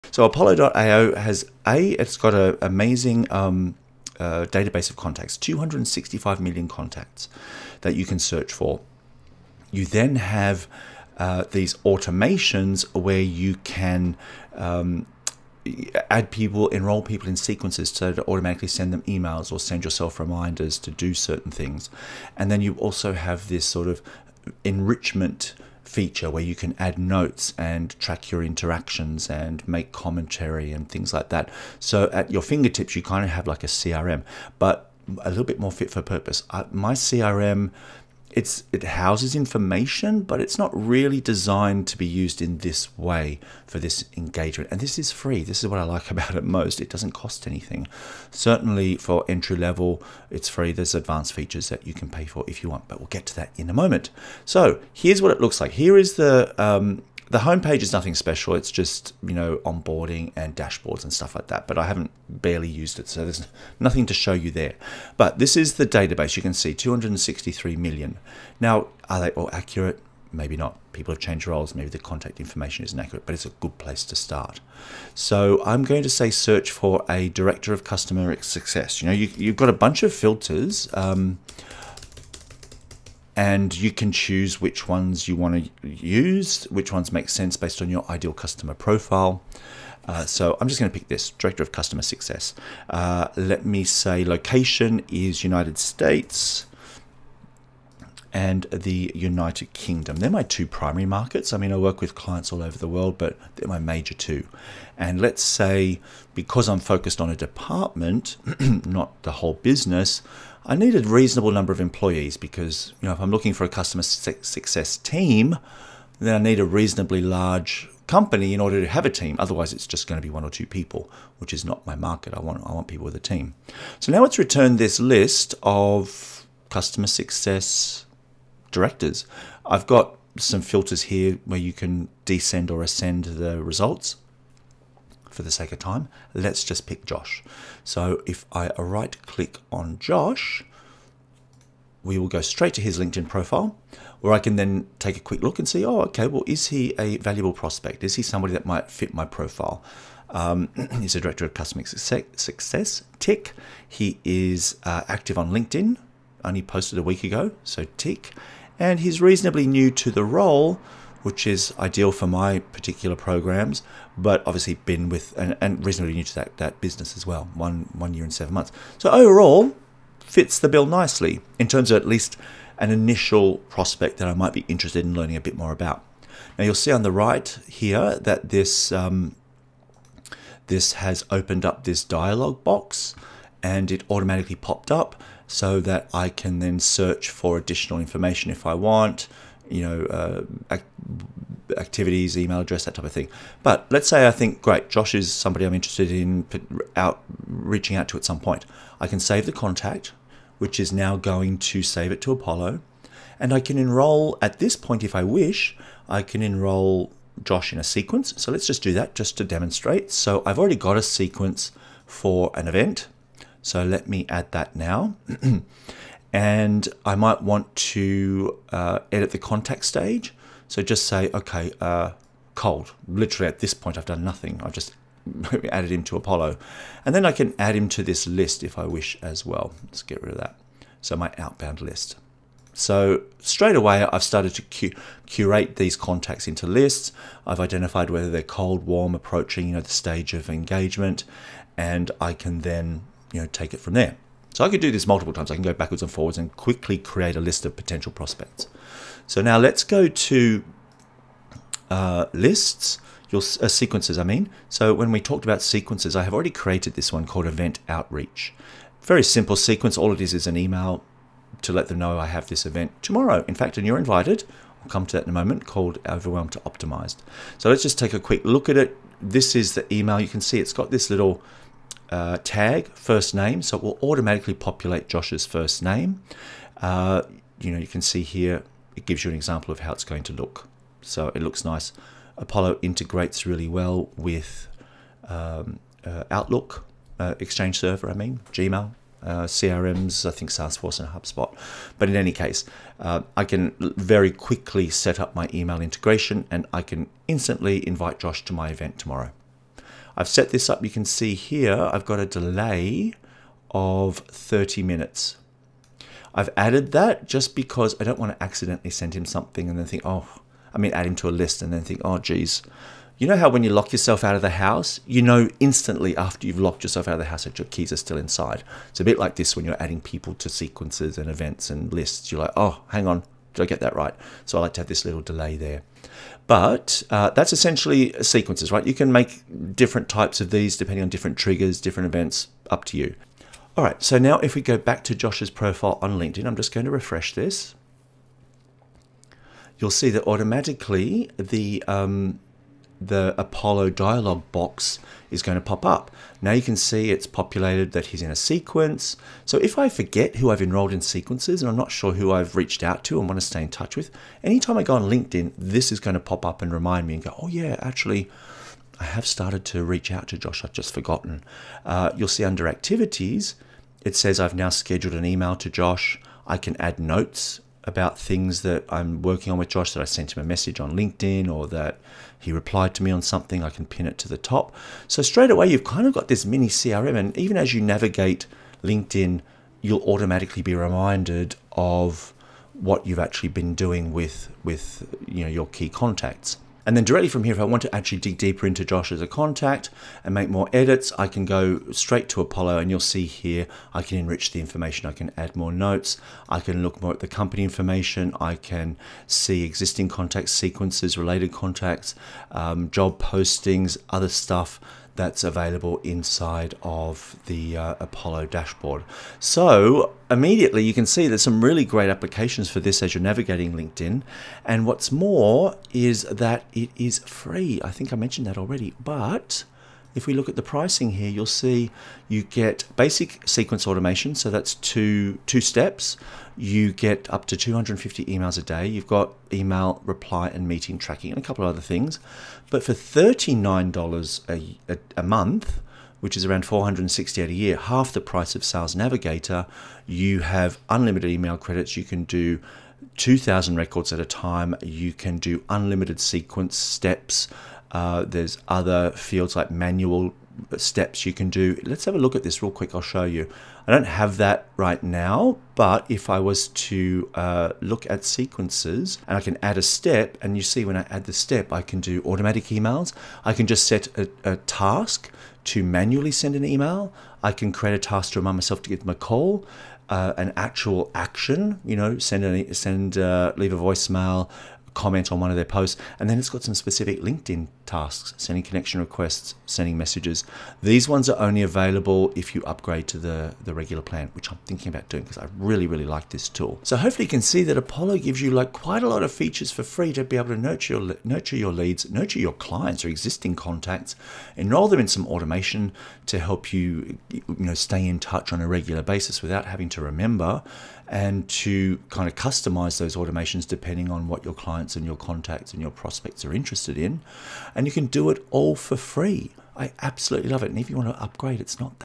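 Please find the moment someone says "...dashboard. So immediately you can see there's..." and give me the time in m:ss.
6:48.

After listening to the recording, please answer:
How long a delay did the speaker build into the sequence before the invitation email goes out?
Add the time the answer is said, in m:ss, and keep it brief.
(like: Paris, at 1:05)
30 minutes, at 5:04.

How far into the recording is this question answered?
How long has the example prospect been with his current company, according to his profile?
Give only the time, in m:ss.
2:47.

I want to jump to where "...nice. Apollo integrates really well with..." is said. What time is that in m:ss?
4:41.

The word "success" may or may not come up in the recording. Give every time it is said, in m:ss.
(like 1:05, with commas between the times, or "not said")
1:18, 1:32, 1:54, 2:07, 2:31.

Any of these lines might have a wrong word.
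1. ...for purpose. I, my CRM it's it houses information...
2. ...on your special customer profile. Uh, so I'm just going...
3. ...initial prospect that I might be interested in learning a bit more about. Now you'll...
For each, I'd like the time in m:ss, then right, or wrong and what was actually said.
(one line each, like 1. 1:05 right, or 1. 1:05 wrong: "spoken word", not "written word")
1. 0:35 right
2. 1:27 wrong: "ideal", not "special"
3. 2:52 right.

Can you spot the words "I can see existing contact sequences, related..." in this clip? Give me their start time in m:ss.
6:38.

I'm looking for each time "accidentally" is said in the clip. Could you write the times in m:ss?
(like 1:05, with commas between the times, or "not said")
5:08.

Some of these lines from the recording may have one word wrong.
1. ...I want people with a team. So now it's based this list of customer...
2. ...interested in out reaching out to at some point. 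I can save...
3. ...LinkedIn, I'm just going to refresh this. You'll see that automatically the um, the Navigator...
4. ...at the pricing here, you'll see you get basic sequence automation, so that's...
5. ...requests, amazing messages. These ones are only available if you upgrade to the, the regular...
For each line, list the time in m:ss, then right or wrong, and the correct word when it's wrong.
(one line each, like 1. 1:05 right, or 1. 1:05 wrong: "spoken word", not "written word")
1. 2:02 wrong: "returned", not "based"
2. 3:15 right
3. 5:36 wrong: "Apollo", not "Navigator"
4. 7:00 right
5. 7:59 wrong: "sending", not "amazing".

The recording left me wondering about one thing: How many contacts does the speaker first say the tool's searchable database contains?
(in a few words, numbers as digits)
265 million.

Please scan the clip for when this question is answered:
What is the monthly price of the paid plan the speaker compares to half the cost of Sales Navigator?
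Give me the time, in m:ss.
7:12.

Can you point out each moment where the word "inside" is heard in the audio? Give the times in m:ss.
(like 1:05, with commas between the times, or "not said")
5:18, 6:45.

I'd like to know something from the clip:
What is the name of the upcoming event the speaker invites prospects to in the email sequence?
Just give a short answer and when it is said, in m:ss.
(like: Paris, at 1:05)
Overwhelmed to Optimized, at 4:26.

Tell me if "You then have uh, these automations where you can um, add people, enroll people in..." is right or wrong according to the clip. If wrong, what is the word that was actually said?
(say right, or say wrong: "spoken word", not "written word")
right.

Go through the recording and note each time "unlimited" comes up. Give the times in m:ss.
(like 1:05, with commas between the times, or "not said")
7:20, 7:25.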